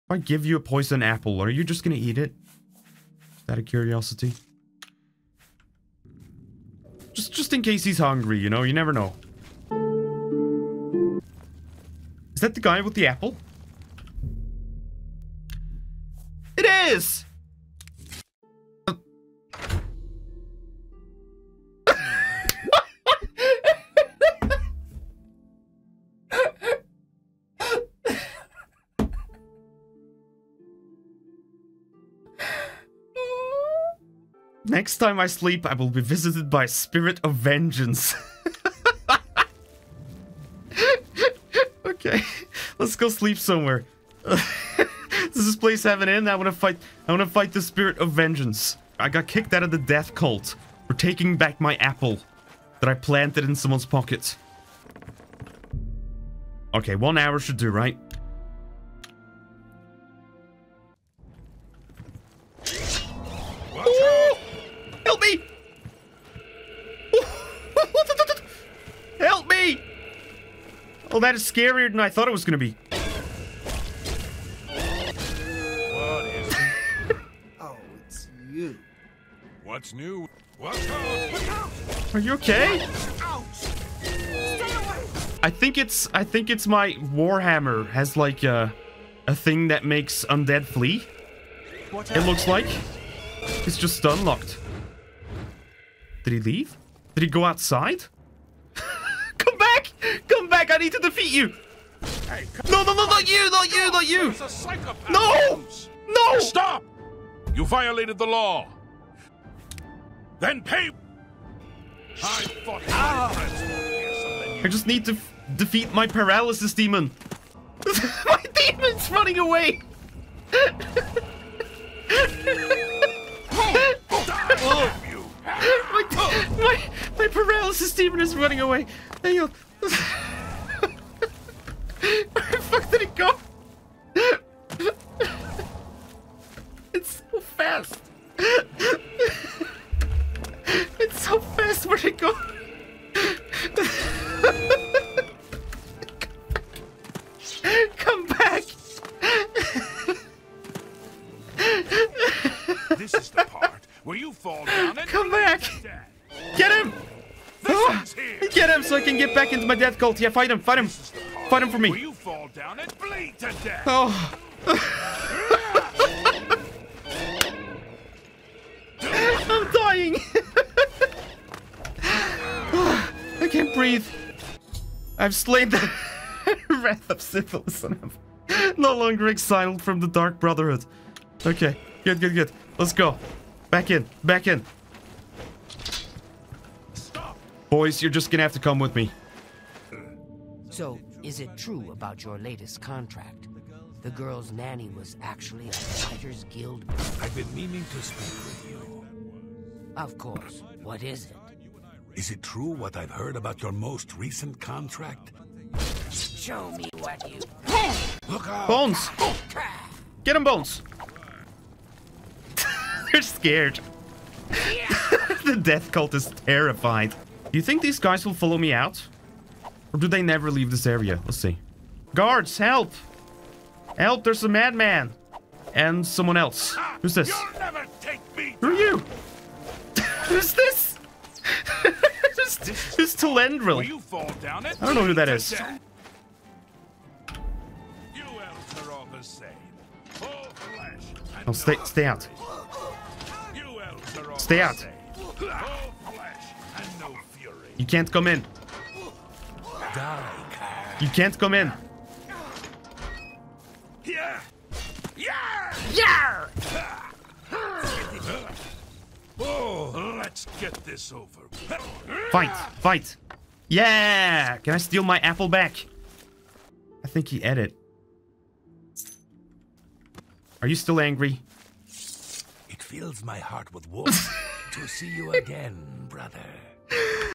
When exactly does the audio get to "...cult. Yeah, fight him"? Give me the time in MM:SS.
02:39.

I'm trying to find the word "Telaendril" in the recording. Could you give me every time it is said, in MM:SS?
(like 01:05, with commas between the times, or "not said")
03:53.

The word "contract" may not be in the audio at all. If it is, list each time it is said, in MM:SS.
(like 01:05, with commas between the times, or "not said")
03:12, 03:24.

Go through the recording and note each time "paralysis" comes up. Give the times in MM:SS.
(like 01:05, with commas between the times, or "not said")
01:56, 02:07.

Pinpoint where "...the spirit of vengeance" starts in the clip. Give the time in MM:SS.
00:47.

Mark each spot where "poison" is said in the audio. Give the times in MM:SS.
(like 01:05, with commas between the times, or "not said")
00:00.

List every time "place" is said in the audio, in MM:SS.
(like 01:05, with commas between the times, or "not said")
00:45.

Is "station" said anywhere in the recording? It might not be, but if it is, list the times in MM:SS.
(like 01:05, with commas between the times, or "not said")
not said.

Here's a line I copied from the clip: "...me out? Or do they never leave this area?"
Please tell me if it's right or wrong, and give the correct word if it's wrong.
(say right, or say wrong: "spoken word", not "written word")
right.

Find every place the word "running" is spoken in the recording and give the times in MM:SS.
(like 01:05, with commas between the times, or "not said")
01:59, 02:08.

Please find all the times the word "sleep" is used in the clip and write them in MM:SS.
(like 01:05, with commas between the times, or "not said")
00:35, 00:43.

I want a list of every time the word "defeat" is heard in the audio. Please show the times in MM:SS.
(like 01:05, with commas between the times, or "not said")
01:40, 01:55.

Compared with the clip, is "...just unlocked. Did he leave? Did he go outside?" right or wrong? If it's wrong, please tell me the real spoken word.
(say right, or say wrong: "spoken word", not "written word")
right.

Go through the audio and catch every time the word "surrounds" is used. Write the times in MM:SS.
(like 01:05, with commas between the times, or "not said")
not said.